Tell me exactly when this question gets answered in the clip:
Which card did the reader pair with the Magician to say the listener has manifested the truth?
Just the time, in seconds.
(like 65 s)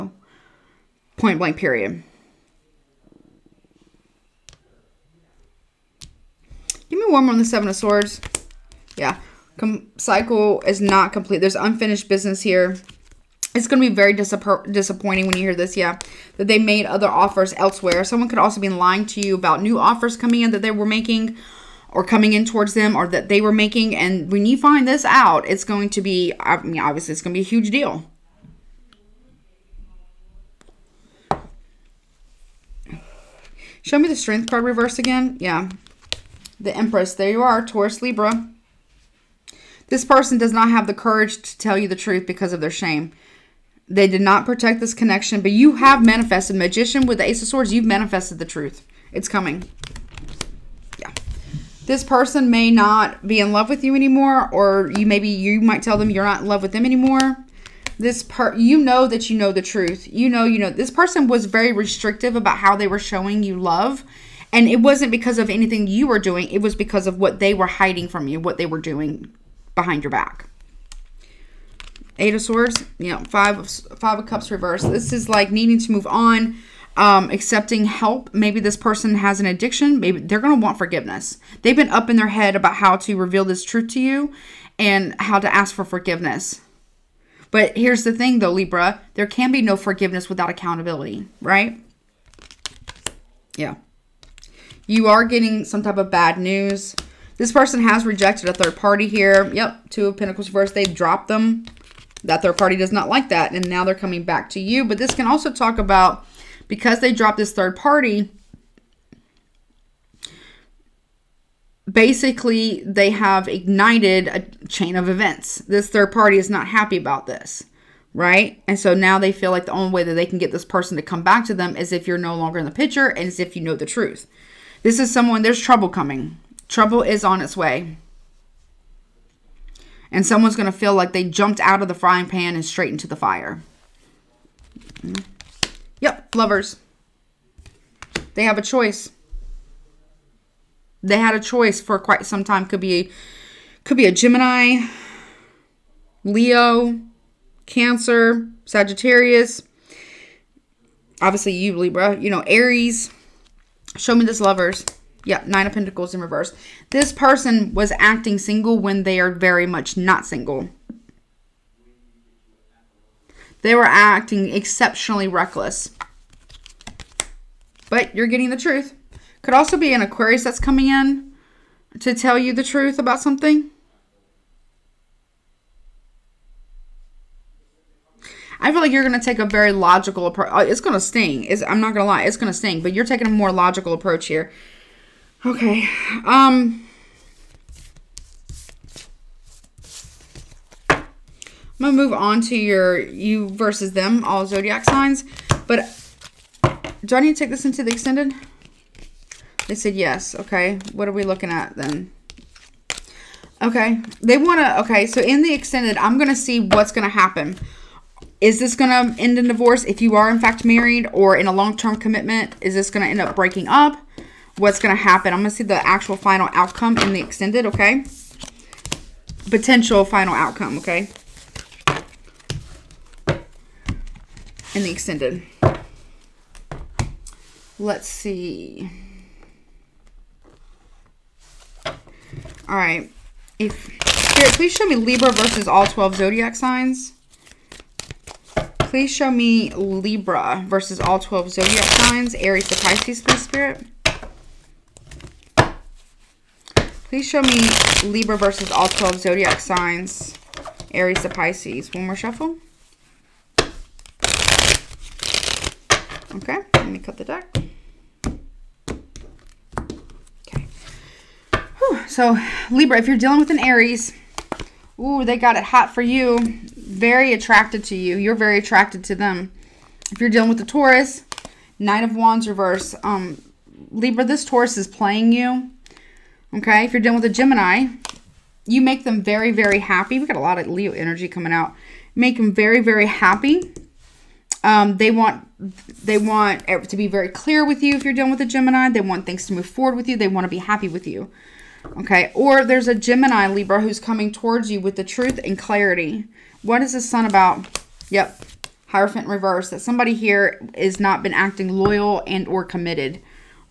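47 s.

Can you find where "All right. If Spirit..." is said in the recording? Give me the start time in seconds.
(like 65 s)
232 s.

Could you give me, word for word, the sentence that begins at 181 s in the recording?
It's, I'm not going to lie.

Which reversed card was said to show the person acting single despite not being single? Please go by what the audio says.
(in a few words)
Nine of Pentacles.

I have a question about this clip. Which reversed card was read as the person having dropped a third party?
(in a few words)
Two of Pentacles.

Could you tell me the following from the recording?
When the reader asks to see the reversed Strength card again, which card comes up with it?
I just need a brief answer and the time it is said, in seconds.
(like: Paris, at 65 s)
The Empress, at 36 s.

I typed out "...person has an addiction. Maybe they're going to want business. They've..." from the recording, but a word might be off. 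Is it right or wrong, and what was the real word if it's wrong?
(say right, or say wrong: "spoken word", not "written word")
wrong: "forgiveness", not "business".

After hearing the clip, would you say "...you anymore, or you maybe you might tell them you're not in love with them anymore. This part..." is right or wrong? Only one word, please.
right.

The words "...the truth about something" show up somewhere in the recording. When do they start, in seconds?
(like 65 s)
172 s.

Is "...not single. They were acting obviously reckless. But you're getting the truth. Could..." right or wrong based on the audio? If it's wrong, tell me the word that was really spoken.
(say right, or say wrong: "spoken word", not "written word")
wrong: "exceptionally", not "obviously".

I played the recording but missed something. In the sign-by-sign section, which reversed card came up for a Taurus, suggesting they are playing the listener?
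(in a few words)
Nine of Wands.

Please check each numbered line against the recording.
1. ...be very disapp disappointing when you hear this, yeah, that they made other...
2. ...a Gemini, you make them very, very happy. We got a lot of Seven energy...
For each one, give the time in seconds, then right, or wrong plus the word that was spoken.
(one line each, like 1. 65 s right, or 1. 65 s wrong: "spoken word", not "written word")
1. 13 s right
2. 277 s wrong: "Leo", not "Seven".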